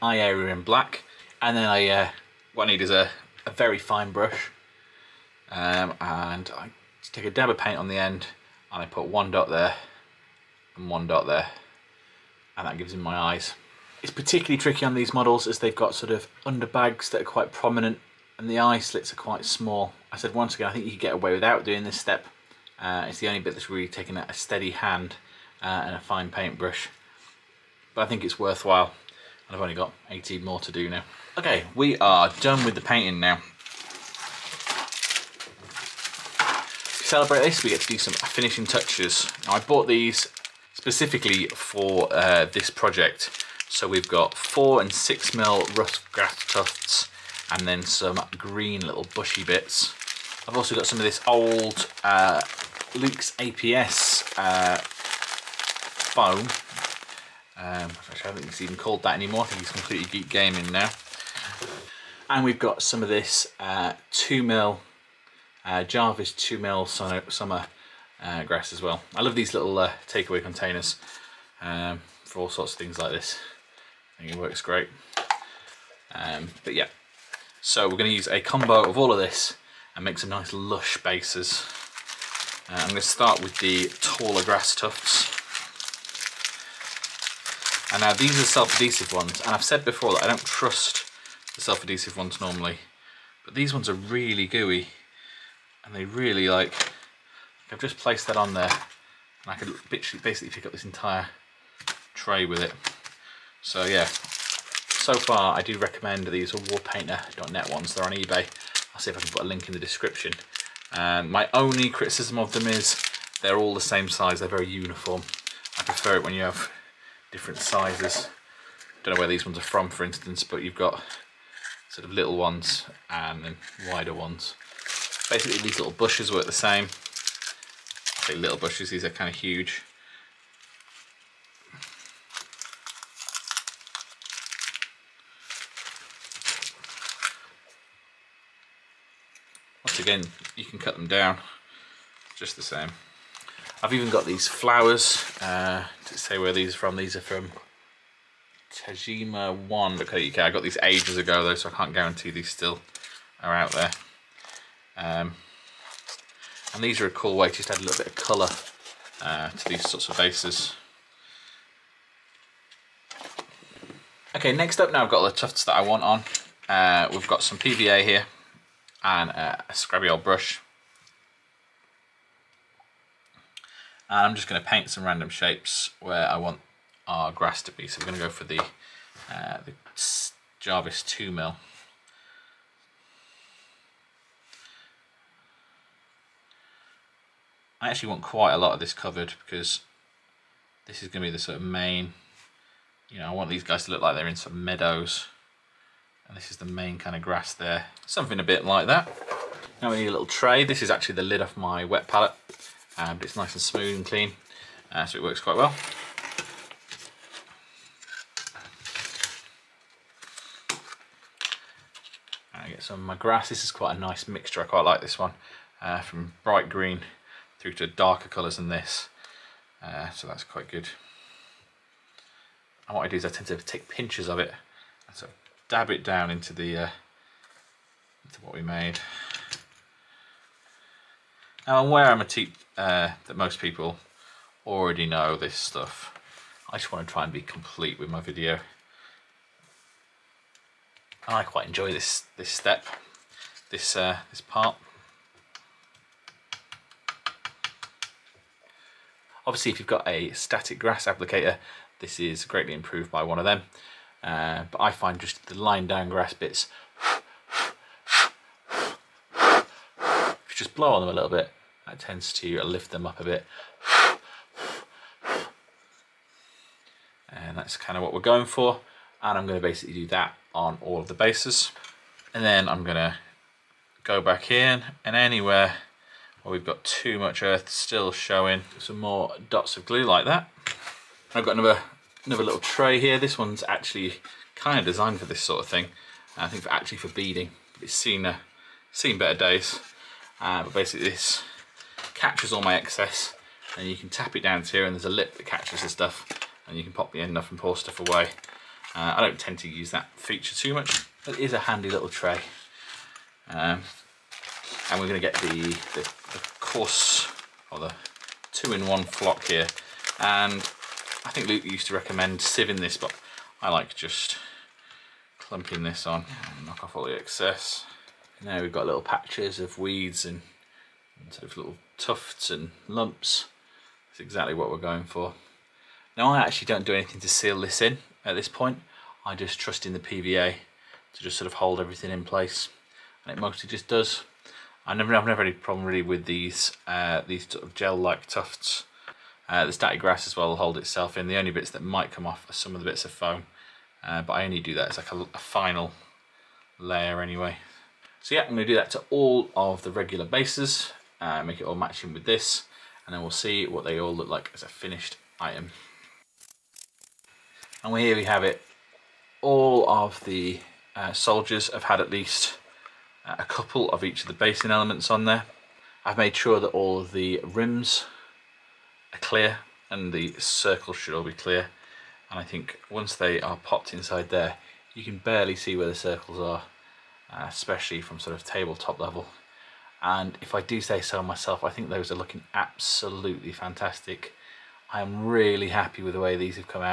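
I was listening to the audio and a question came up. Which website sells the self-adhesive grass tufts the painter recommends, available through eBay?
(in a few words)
warpainter.net.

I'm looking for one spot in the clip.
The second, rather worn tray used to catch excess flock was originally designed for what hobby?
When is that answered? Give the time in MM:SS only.
04:47.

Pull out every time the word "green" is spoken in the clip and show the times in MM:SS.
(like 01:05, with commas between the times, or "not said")
00:48, 03:36.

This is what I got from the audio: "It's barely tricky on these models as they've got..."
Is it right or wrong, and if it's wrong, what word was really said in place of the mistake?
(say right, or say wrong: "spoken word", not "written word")
wrong: "particularly", not "barely".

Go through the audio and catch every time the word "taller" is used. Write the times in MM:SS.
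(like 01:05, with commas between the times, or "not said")
01:23.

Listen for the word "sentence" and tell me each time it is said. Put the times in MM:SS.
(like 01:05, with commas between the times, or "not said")
not said.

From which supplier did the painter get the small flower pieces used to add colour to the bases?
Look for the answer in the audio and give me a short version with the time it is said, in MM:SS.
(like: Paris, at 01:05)
Tajima1, at 02:28.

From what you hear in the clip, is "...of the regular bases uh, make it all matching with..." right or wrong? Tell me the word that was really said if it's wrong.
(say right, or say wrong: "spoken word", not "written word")
right.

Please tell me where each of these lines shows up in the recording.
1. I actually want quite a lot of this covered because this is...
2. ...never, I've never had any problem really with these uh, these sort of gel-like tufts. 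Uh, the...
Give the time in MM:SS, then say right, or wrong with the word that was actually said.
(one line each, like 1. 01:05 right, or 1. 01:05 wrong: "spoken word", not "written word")
1. 03:07 right
2. 05:34 right.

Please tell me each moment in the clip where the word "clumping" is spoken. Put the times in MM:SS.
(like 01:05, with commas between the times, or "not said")
05:15.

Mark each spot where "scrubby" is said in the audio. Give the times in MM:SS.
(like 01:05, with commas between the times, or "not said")
02:49.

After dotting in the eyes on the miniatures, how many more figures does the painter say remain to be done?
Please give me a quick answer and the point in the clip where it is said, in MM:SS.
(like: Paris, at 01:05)
18, at 00:30.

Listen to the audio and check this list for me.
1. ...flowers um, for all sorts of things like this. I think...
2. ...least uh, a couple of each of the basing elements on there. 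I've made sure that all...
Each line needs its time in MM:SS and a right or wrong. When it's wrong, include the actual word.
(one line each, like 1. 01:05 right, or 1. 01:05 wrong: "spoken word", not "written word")
1. 01:10 wrong: "containers", not "flowers"
2. 06:02 right.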